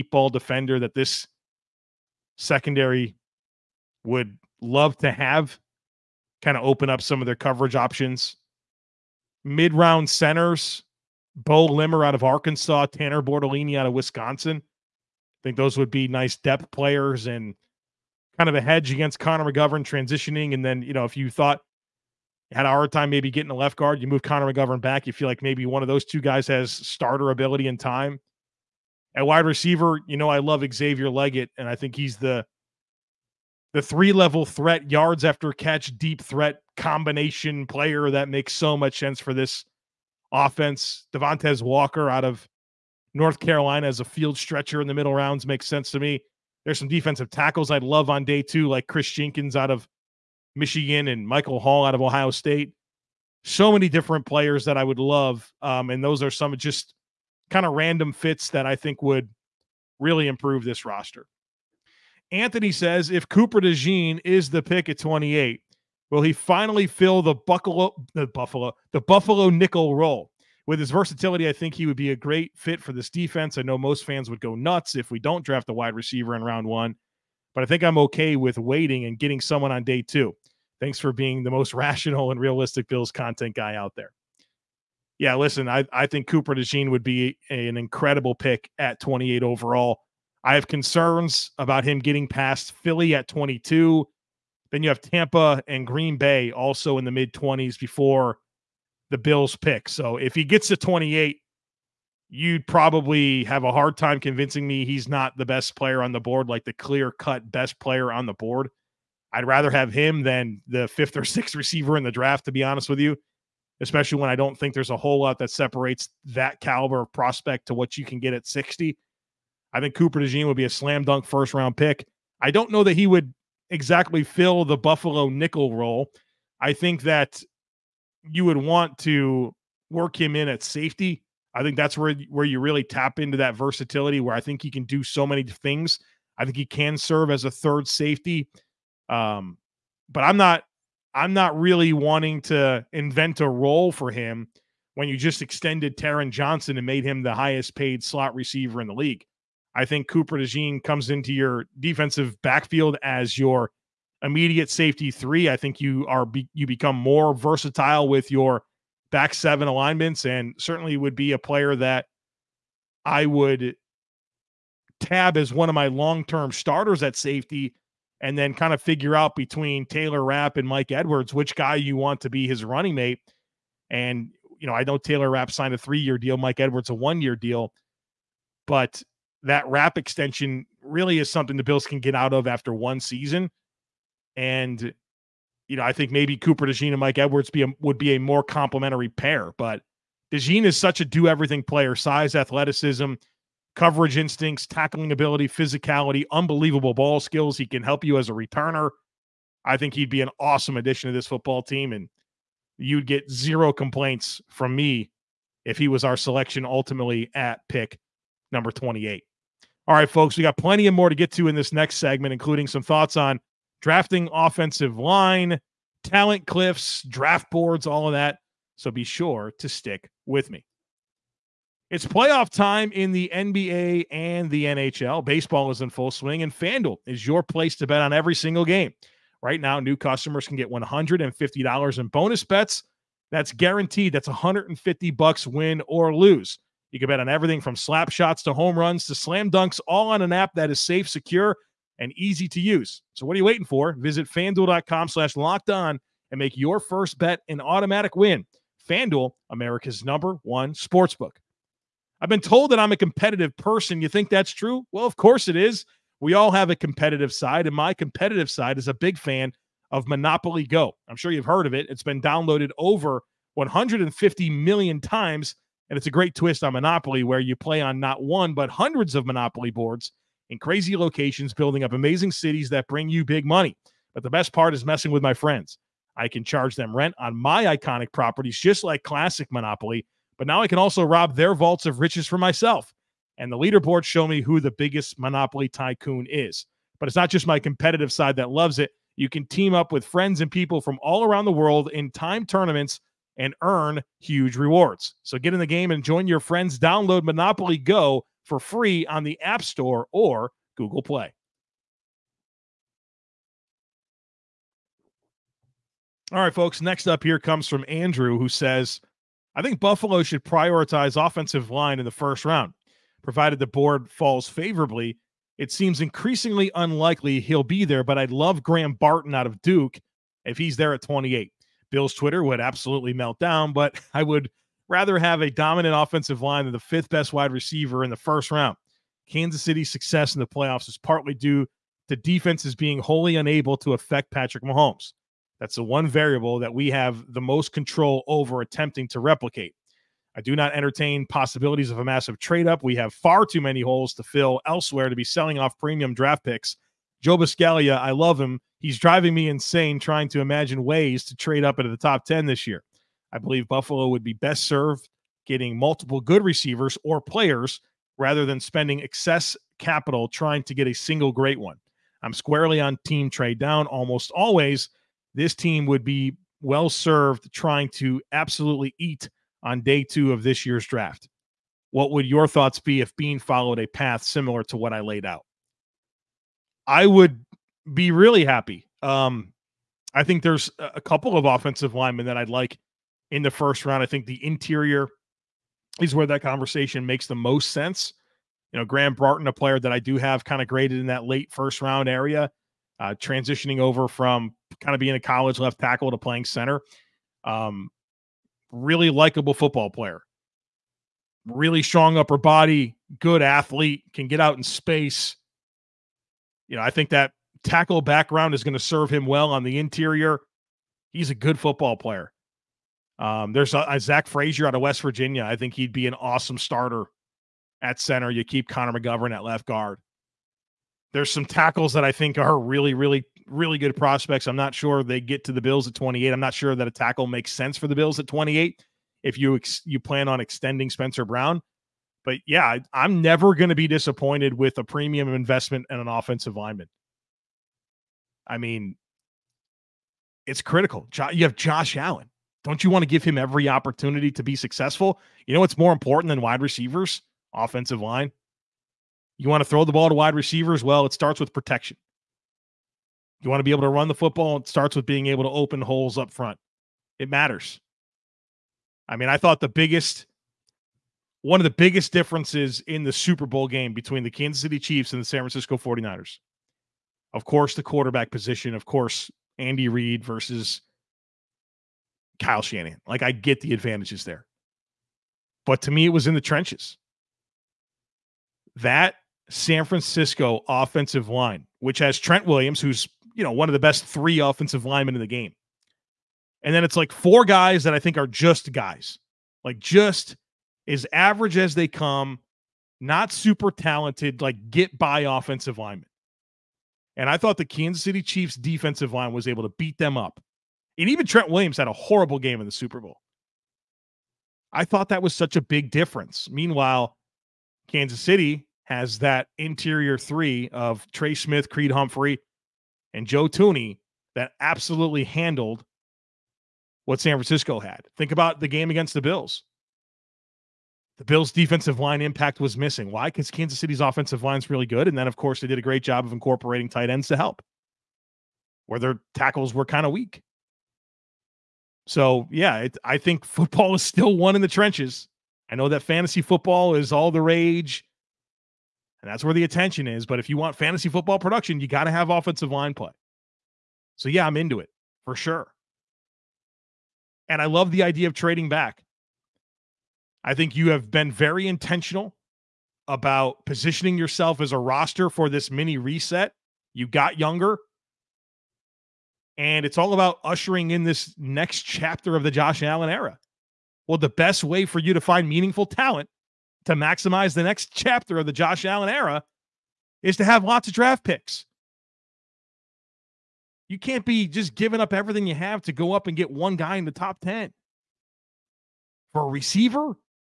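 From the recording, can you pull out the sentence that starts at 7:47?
Of course, the quarterback position, of course, Andy Reid versus Kyle Shanahan.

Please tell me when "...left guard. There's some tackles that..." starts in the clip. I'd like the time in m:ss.
6:59.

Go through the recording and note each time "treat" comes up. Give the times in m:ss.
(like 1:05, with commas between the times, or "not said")
not said.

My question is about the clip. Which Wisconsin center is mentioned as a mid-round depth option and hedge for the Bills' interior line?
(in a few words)
Tanner Bortolini.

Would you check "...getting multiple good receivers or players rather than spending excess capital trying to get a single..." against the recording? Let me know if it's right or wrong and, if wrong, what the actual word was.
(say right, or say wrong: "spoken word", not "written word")
right.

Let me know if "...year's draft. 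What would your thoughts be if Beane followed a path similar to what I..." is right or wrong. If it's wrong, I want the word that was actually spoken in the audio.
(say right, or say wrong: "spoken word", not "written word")
right.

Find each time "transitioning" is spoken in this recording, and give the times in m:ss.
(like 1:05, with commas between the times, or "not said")
0:19, 6:33.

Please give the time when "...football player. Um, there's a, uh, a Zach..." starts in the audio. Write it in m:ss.
6:51.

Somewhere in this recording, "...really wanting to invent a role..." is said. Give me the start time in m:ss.
2:21.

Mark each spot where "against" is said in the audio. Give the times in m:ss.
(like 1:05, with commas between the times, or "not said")
0:18, 8:38.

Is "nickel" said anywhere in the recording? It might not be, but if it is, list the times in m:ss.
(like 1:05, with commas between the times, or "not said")
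1:09, 2:05.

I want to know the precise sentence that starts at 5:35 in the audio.
That's the one variable that we have the most control over attempting to replicate.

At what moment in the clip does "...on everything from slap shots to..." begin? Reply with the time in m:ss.
3:57.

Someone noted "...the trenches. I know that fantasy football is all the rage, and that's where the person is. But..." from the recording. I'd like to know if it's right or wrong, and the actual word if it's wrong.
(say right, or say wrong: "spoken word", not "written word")
wrong: "attention", not "person".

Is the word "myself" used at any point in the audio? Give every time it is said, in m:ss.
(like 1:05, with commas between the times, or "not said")
4:42.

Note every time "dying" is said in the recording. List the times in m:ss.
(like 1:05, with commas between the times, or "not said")
not said.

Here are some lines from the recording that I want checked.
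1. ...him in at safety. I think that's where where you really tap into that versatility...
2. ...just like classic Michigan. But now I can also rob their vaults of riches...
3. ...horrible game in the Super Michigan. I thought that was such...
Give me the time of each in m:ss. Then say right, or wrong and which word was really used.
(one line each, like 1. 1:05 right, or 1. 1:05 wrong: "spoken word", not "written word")
1. 2:10 right
2. 4:38 wrong: "Monopoly", not "Michigan"
3. 8:21 wrong: "Bowl", not "Michigan".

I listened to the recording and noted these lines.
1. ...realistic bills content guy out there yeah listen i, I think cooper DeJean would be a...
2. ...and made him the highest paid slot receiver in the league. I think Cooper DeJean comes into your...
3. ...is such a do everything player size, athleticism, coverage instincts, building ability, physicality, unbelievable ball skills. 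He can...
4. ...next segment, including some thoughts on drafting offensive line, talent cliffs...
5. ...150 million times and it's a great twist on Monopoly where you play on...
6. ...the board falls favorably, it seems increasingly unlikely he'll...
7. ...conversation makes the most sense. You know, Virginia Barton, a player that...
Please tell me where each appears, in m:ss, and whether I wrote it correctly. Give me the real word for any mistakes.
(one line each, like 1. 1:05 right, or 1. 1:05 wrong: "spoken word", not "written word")
1. 1:22 right
2. 2:26 right
3. 3:10 wrong: "tackling", not "building"
4. 3:31 right
5. 4:23 right
6. 5:13 right
7. 6:26 wrong: "Graham", not "Virginia".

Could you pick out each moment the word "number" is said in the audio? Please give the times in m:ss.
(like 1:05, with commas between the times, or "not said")
3:28, 4:10.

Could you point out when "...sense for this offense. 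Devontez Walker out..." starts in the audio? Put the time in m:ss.
0:38.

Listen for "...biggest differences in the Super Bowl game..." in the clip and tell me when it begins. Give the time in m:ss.
7:41.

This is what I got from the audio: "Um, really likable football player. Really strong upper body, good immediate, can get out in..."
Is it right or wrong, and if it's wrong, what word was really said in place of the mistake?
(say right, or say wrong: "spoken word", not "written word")
wrong: "athlete", not "immediate".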